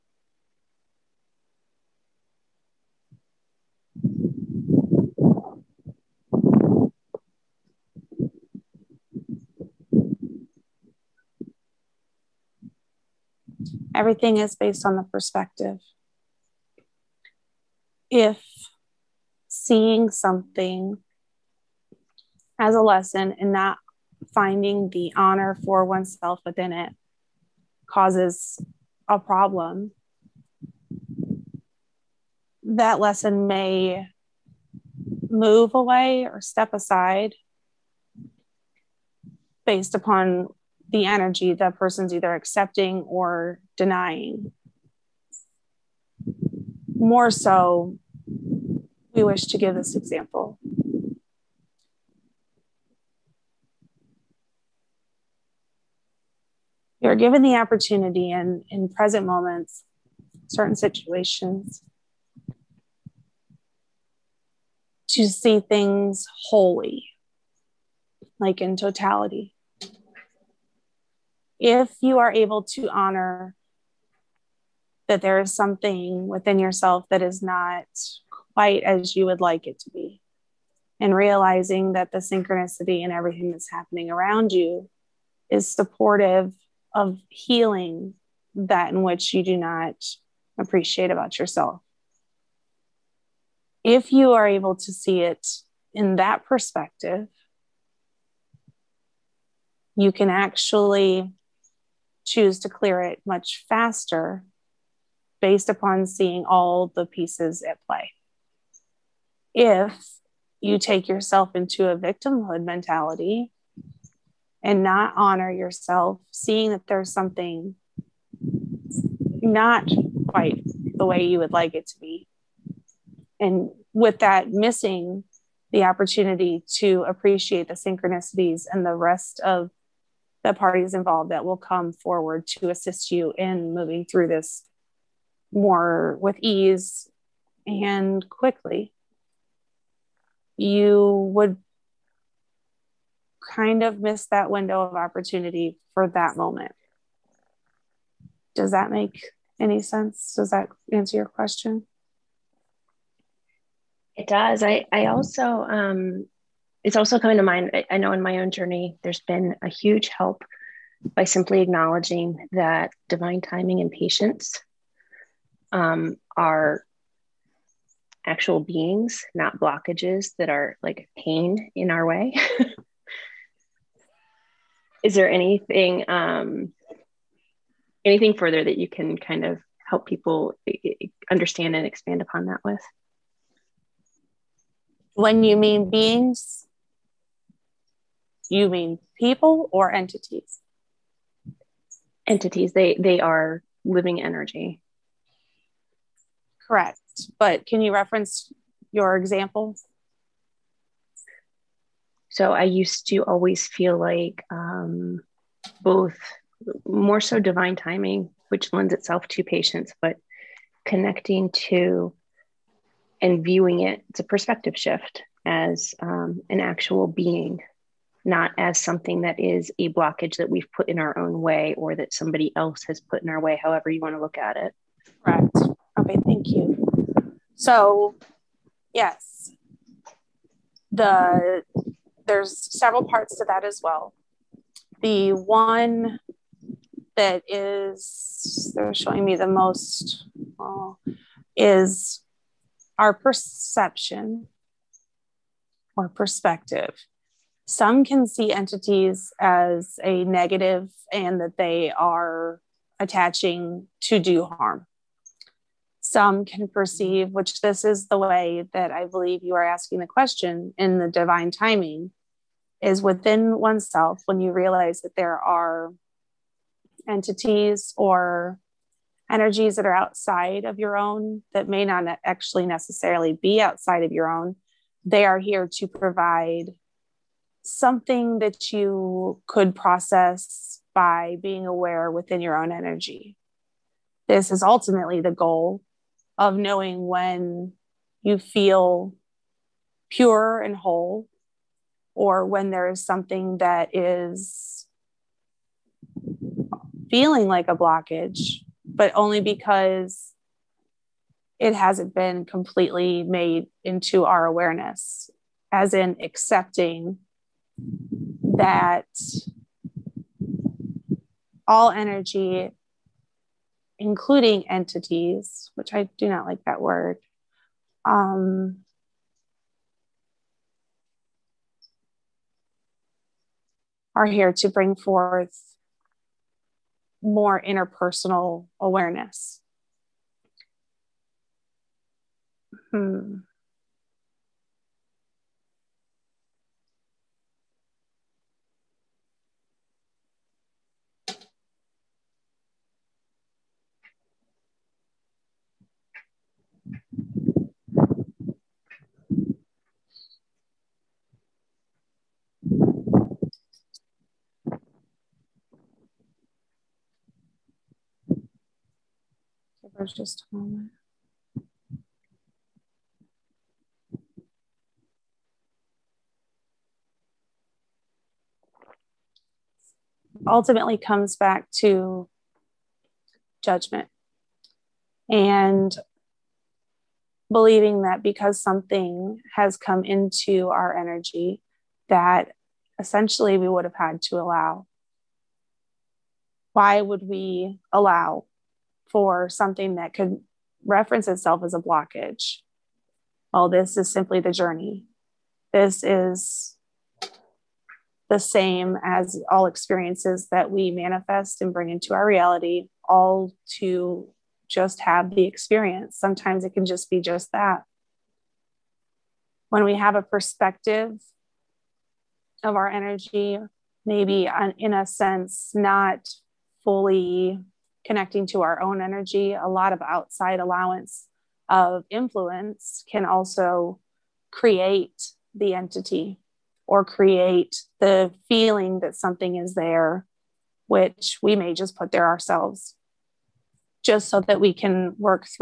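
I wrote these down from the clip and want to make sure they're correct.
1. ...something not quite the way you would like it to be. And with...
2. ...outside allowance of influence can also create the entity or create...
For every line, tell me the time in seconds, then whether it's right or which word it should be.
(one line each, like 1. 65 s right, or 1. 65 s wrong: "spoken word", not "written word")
1. 117 s right
2. 420 s right.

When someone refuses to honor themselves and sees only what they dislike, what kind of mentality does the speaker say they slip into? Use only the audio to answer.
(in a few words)
victimhood mentality.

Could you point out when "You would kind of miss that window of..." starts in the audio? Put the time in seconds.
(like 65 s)
140 s.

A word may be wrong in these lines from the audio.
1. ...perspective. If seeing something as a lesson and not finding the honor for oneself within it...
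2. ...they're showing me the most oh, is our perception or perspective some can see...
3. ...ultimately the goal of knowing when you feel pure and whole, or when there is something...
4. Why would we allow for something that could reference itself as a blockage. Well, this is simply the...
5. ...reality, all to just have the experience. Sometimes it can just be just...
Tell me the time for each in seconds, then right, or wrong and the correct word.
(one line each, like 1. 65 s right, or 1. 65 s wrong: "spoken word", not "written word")
1. 15 s right
2. 238 s right
3. 284 s right
4. 386 s right
5. 402 s right.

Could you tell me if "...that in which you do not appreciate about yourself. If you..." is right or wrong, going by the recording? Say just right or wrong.
right.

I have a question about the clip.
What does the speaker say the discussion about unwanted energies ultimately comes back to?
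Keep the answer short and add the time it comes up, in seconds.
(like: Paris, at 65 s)
judgment, at 373 s.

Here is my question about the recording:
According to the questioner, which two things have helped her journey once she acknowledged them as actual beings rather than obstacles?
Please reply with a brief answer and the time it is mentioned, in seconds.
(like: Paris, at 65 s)
divine timing and patience, at 163 s.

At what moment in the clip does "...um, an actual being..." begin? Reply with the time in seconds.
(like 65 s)
216 s.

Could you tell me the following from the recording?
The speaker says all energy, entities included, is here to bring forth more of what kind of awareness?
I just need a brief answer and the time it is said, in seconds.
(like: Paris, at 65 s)
interpersonal awareness, at 327 s.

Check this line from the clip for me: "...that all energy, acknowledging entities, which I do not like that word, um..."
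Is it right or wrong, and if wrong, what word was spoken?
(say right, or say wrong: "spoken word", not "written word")
wrong: "including", not "acknowledging".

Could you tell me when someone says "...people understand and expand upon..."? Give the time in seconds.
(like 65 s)
180 s.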